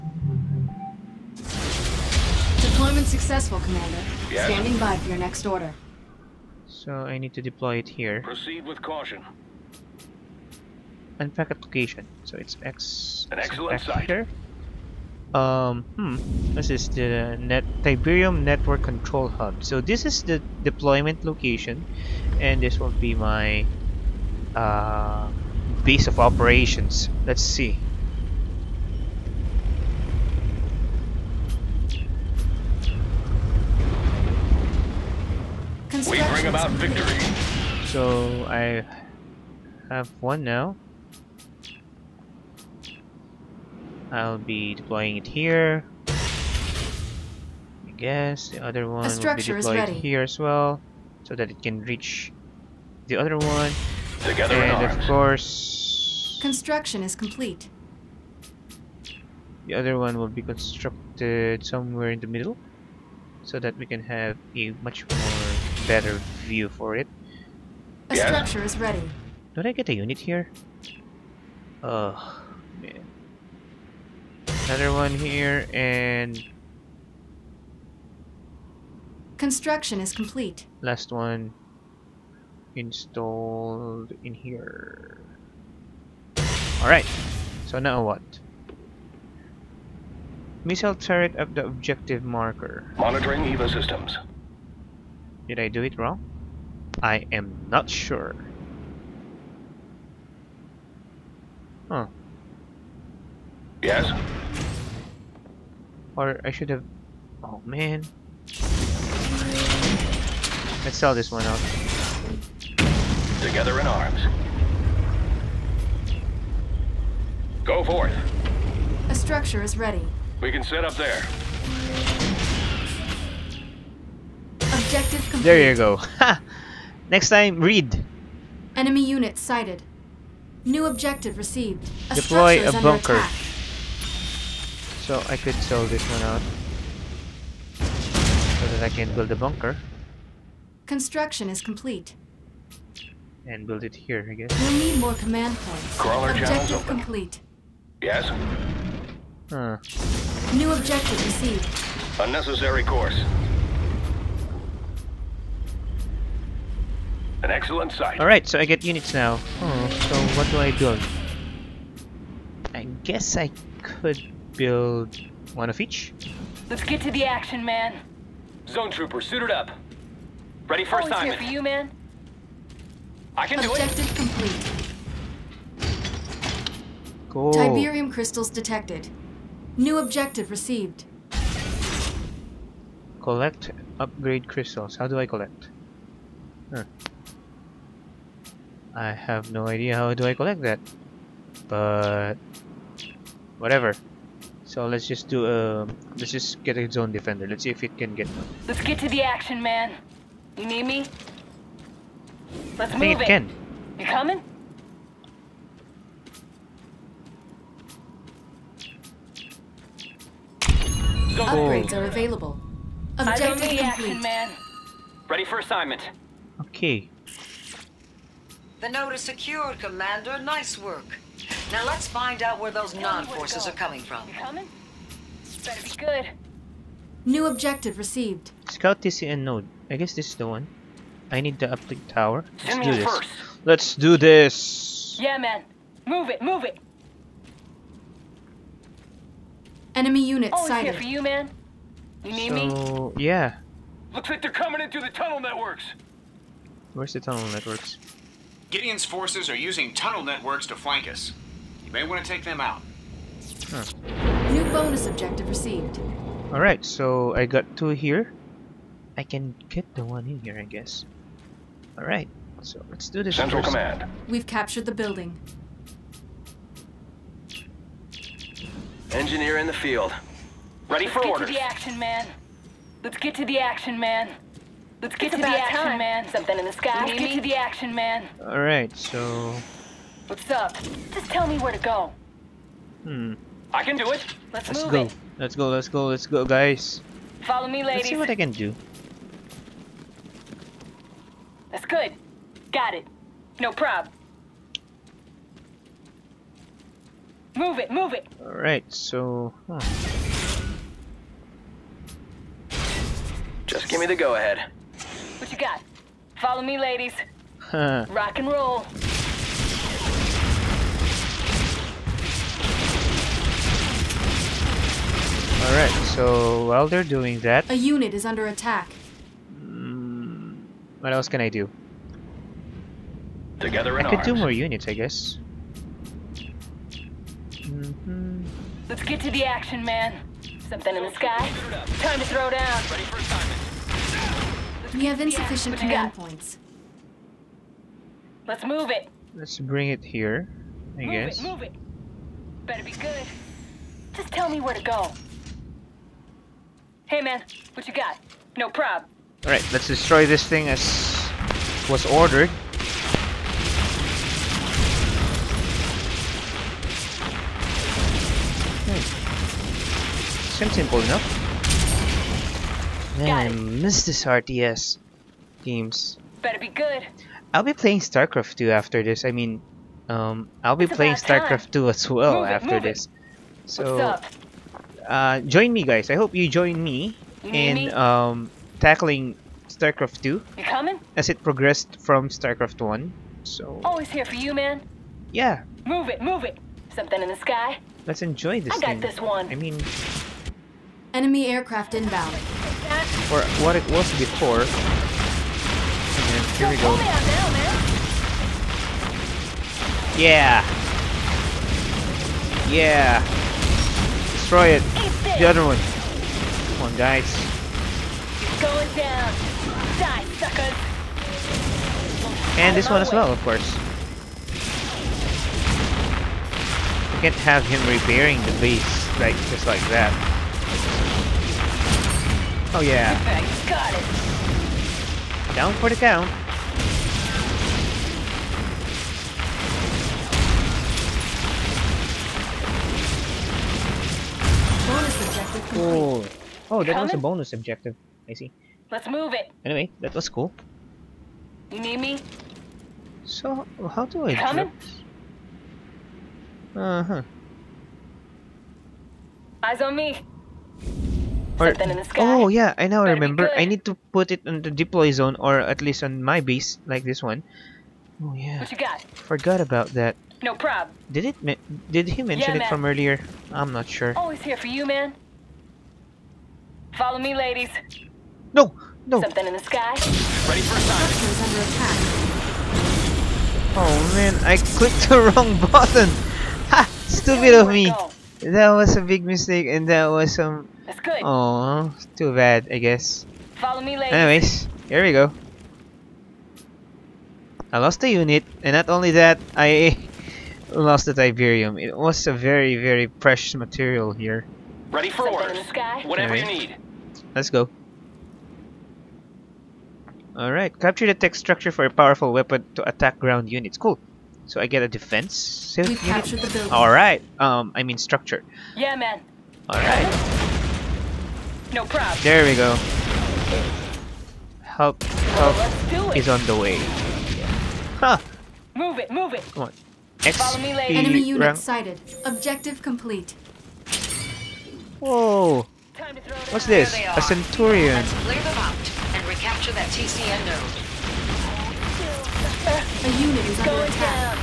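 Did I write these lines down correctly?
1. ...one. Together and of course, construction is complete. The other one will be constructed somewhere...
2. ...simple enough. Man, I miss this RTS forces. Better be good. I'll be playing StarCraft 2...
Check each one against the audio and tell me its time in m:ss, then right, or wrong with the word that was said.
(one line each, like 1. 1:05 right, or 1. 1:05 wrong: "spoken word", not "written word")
1. 0:53 right
2. 6:00 wrong: "games", not "forces".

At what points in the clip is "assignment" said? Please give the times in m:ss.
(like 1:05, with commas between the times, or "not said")
2:51, 3:35, 5:33.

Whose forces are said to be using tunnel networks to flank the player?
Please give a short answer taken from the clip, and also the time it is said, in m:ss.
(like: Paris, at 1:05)
Gideon's, at 4:08.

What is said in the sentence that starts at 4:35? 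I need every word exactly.
Let's get it's to the action, time.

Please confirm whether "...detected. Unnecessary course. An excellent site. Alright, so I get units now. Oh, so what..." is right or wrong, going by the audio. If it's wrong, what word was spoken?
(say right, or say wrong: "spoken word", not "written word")
wrong: "received", not "detected".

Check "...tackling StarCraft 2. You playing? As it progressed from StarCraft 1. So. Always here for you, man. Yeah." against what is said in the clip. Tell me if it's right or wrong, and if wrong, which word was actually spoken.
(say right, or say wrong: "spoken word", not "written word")
wrong: "coming", not "playing".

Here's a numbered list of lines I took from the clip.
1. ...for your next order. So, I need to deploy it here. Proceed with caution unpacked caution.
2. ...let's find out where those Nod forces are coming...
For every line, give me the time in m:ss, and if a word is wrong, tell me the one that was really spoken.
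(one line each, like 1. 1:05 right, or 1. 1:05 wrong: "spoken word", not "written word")
1. 0:04 wrong: "location", not "caution"
2. 3:41 right.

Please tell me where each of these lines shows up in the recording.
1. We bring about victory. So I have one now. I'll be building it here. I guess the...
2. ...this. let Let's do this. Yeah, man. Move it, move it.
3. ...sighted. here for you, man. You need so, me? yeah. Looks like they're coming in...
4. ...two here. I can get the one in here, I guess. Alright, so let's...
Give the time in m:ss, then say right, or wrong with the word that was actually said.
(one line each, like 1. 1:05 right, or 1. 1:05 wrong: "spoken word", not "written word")
1. 0:36 wrong: "deploying", not "building"
2. 3:52 right
3. 4:00 right
4. 4:17 right.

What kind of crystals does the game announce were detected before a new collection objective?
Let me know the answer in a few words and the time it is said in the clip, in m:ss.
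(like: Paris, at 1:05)
Upgrade crystals, at 3:03.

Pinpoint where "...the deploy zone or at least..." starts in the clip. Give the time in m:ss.
7:34.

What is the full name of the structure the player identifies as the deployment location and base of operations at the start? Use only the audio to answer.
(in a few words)
Tiberium Network Control Hub.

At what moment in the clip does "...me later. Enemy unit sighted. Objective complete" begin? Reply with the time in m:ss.
8:40.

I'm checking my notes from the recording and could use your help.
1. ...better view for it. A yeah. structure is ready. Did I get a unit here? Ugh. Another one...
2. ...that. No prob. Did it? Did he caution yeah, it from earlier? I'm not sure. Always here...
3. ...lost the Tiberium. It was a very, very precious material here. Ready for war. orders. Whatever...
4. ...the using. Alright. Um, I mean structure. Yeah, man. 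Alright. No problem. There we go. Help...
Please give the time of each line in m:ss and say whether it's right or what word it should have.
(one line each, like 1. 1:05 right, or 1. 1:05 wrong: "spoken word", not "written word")
1. 1:05 right
2. 7:39 wrong: "mention", not "caution"
3. 8:10 right
4. 8:26 wrong: "building", not "using".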